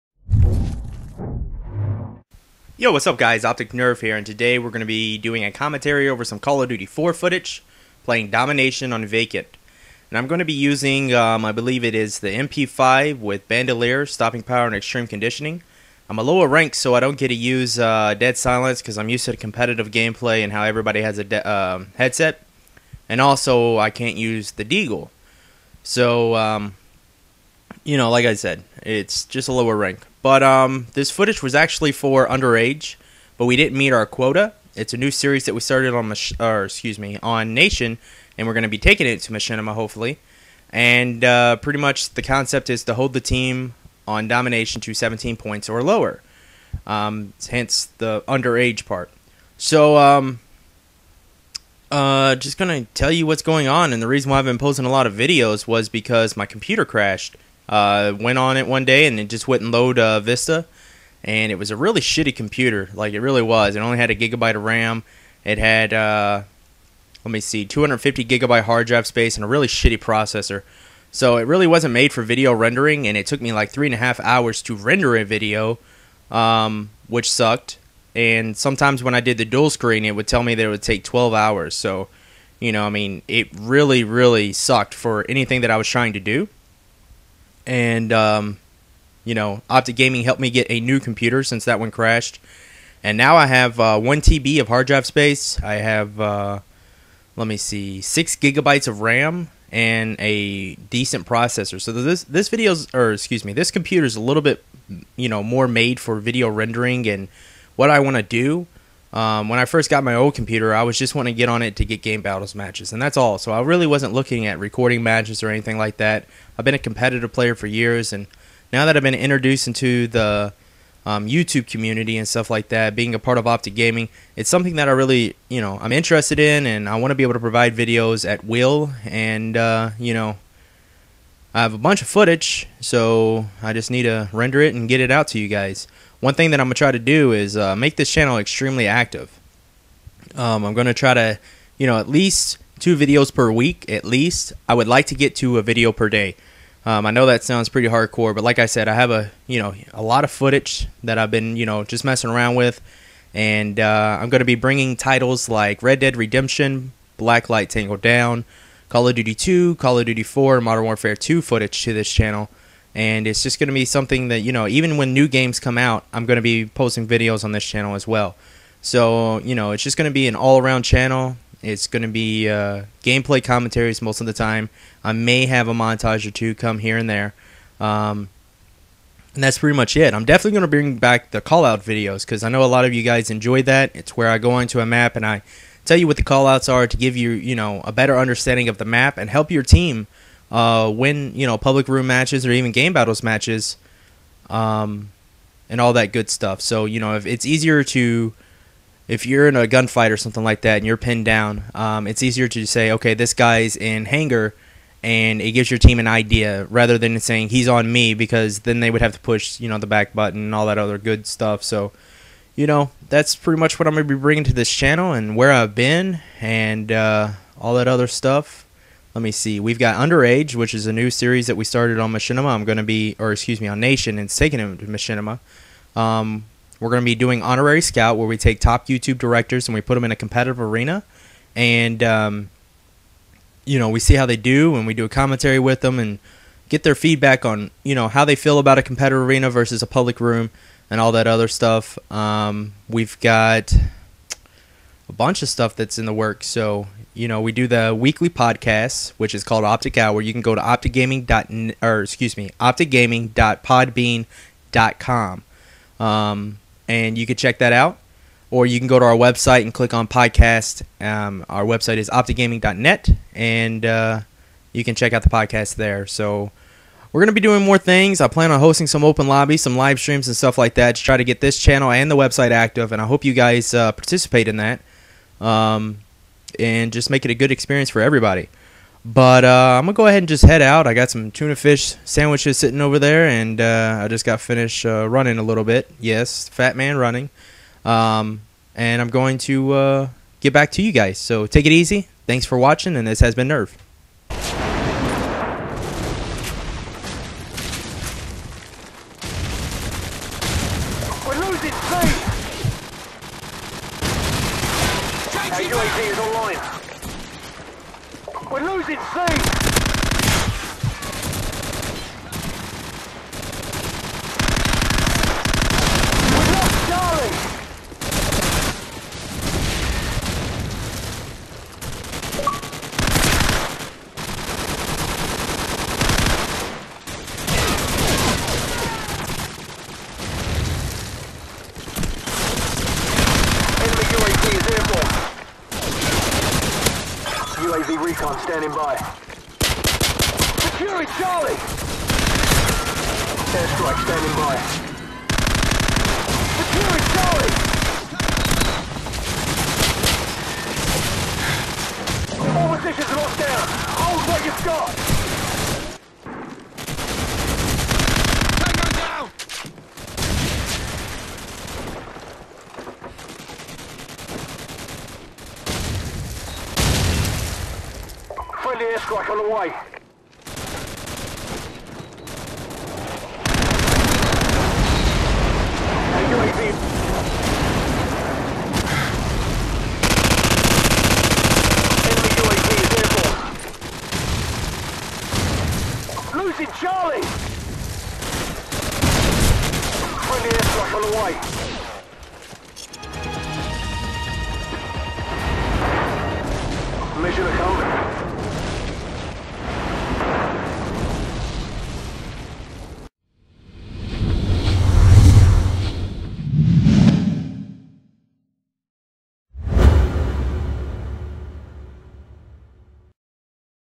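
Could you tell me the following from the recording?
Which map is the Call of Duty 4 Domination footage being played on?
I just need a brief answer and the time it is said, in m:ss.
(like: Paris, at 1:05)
Vacant, at 0:09.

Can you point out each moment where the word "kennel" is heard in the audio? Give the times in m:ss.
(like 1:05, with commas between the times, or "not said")
not said.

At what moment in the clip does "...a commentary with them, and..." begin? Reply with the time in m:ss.
3:55.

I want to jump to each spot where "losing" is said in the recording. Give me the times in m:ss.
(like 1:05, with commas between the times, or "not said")
5:01, 5:08, 6:26.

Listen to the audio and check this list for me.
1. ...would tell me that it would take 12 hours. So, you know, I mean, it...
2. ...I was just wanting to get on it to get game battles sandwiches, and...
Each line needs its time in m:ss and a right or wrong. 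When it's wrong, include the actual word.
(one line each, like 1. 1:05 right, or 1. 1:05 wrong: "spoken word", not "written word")
1. 1:20 right
2. 1:50 wrong: "matches", not "sandwiches".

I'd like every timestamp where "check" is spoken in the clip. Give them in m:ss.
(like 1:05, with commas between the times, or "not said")
4:17, 4:24.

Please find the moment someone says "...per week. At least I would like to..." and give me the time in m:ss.
2:23.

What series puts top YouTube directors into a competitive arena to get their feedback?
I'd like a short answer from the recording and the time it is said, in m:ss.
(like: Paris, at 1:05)
Honorary Scout, at 3:47.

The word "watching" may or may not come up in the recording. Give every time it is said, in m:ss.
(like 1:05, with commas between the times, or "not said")
4:52.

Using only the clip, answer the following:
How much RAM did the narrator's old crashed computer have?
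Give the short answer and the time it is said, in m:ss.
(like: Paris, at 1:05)
1 gigabyte, at 1:04.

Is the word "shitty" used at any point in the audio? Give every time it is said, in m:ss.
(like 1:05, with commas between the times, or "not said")
1:02, 1:09.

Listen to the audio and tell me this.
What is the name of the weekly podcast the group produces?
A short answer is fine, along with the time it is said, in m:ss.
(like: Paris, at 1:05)
Optic Hour, at 4:09.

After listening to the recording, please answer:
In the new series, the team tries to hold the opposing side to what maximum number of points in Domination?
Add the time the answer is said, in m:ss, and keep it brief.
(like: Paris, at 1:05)
17, at 0:44.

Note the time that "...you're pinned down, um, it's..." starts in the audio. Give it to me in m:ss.
3:20.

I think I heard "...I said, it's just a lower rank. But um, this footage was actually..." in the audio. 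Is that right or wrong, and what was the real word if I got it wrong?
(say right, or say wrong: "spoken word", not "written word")
right.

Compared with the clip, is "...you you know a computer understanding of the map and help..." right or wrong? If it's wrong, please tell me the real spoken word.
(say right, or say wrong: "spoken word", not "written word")
wrong: "better", not "computer".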